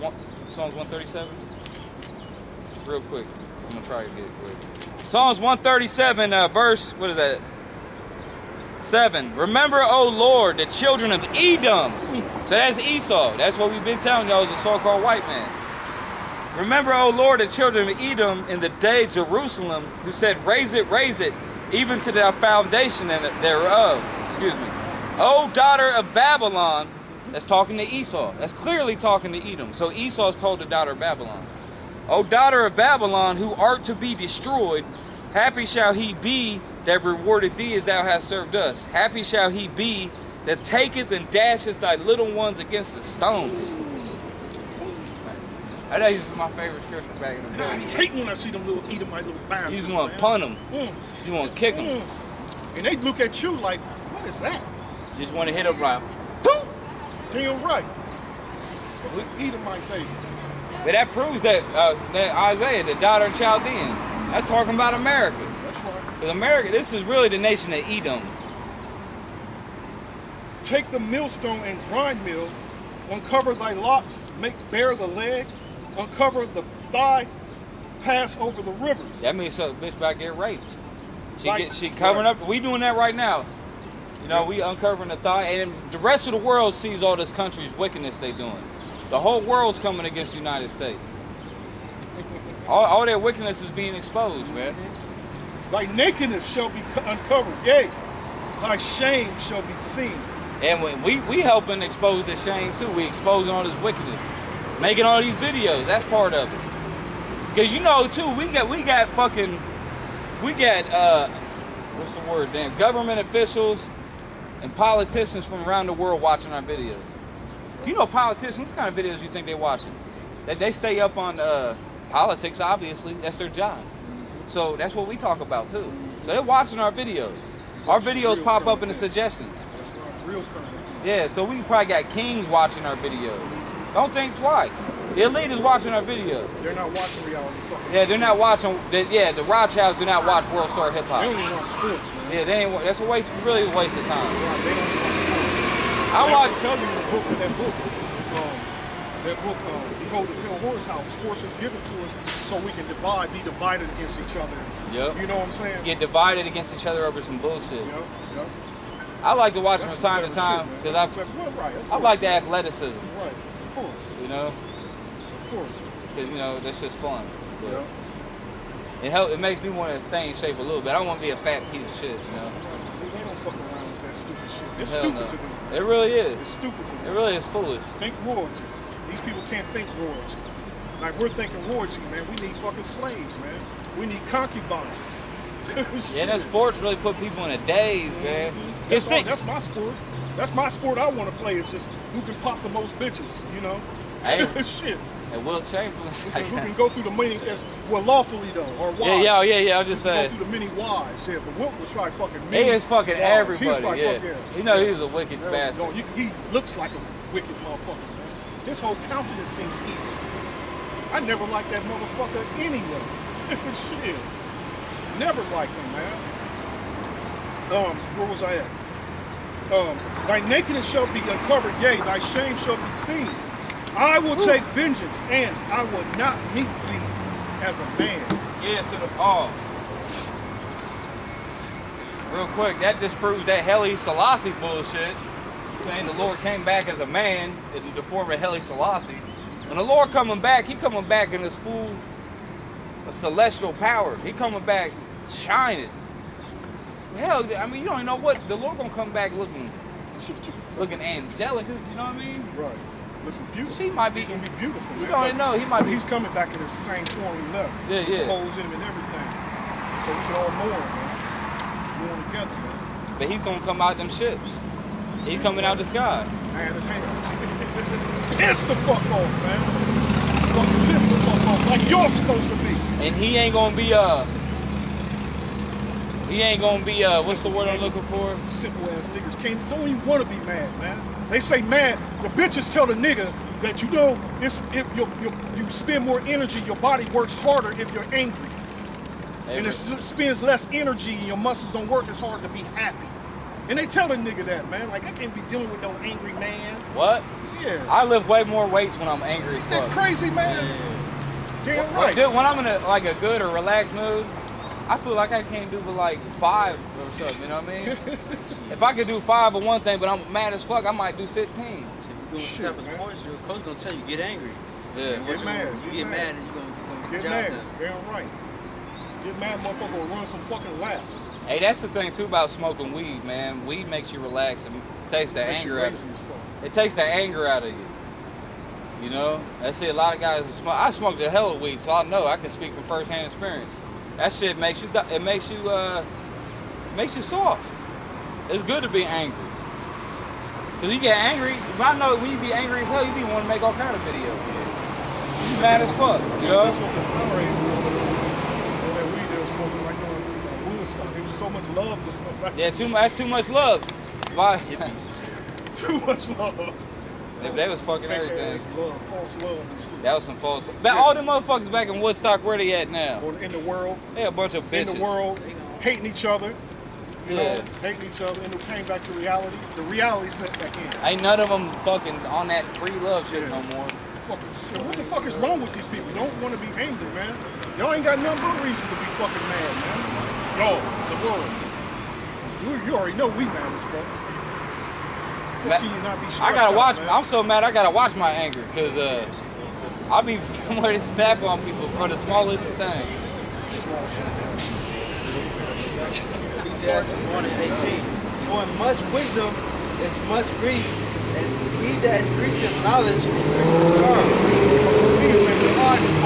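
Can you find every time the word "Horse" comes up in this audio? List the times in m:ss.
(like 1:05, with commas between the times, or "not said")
2:30.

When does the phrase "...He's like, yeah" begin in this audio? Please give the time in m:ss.
3:23.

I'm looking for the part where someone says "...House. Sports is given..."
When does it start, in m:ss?
2:30.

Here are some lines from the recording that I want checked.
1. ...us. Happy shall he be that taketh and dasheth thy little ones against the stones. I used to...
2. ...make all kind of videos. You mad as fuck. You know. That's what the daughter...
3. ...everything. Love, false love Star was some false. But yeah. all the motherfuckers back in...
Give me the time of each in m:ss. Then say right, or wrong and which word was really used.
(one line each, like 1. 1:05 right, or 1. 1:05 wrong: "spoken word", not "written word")
1. 0:38 right
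2. 5:43 wrong: "flower", not "daughter"
3. 5:58 wrong: "That", not "Star".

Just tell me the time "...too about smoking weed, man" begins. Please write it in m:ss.
5:22.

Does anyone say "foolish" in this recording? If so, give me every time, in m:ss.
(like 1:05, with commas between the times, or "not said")
2:57.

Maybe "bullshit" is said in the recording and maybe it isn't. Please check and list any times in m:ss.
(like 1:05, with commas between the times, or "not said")
2:37, 3:54.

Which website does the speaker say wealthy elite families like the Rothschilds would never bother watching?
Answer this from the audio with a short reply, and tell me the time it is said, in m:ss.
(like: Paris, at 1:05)
World Star Hip Hop, at 2:20.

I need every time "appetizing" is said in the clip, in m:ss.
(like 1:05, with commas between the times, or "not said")
not said.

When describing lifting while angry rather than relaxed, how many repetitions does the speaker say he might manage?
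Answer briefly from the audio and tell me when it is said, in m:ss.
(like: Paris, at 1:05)
15, at 5:11.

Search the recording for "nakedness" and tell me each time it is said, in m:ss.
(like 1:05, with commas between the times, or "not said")
1:35, 3:40.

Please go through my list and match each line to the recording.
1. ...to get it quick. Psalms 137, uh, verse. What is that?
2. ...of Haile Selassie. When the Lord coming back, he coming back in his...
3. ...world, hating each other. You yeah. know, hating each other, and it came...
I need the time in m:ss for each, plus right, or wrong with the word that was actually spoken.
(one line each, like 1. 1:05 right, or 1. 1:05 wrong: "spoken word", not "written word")
1. 0:04 right
2. 3:58 right
3. 6:05 right.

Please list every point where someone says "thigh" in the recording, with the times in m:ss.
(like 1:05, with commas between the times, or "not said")
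1:16, 1:25.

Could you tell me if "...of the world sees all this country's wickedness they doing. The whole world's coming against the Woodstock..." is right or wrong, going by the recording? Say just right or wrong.
wrong.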